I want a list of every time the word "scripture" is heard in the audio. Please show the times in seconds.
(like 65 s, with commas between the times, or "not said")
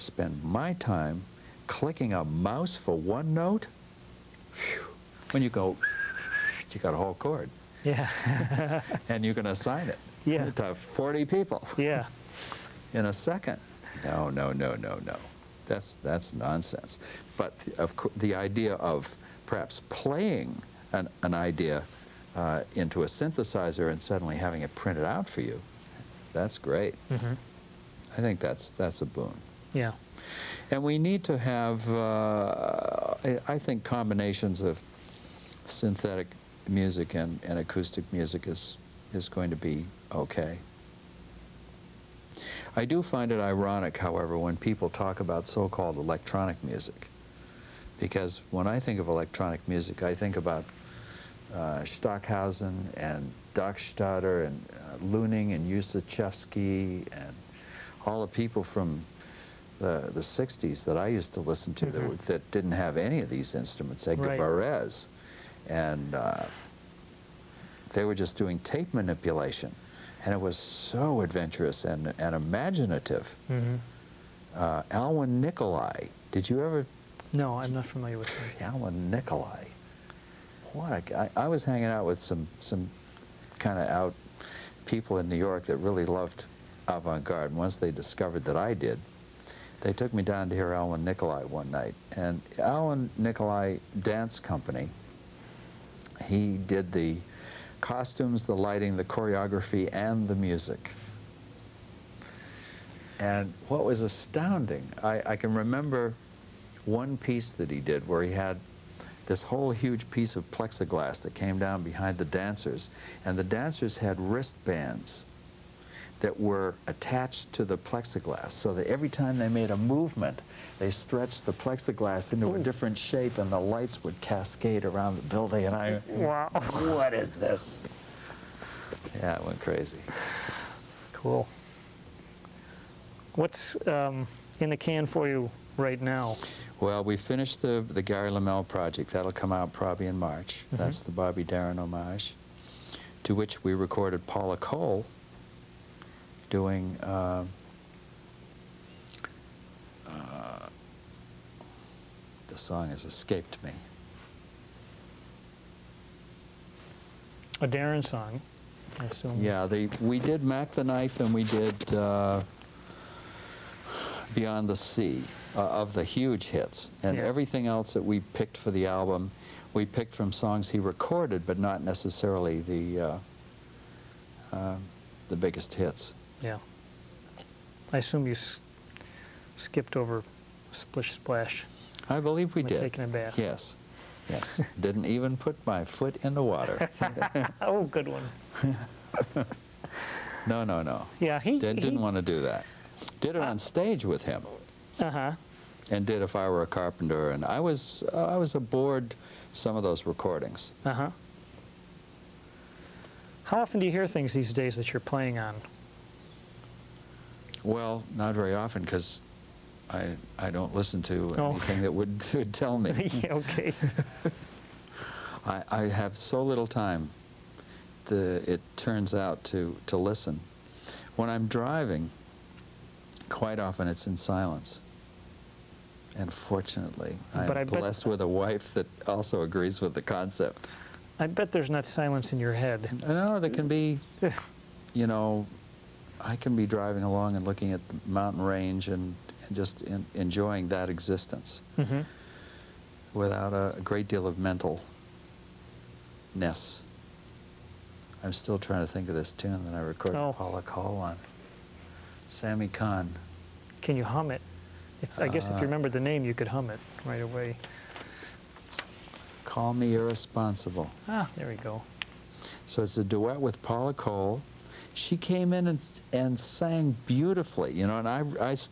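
not said.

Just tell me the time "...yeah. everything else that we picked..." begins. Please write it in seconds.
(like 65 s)
167 s.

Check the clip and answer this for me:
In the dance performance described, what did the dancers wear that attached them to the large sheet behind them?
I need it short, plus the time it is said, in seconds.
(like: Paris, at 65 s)
wristbands, at 114 s.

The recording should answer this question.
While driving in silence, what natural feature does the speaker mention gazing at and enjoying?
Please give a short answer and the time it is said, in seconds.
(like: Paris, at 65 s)
mountain range, at 238 s.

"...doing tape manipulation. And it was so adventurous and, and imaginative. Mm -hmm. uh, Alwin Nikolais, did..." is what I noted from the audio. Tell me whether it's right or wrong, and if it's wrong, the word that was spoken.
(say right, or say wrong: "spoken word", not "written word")
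right.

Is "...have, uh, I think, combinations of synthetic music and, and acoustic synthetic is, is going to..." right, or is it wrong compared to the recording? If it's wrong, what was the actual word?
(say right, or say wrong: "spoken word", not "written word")
wrong: "music", not "synthetic".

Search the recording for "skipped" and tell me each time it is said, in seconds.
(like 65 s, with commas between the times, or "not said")
179 s.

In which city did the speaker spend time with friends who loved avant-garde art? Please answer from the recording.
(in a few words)
New York.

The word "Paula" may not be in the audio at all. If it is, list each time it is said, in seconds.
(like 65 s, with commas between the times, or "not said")
144 s, 250 s, 263 s.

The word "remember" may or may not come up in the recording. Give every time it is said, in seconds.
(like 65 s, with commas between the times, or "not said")
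105 s, 255 s.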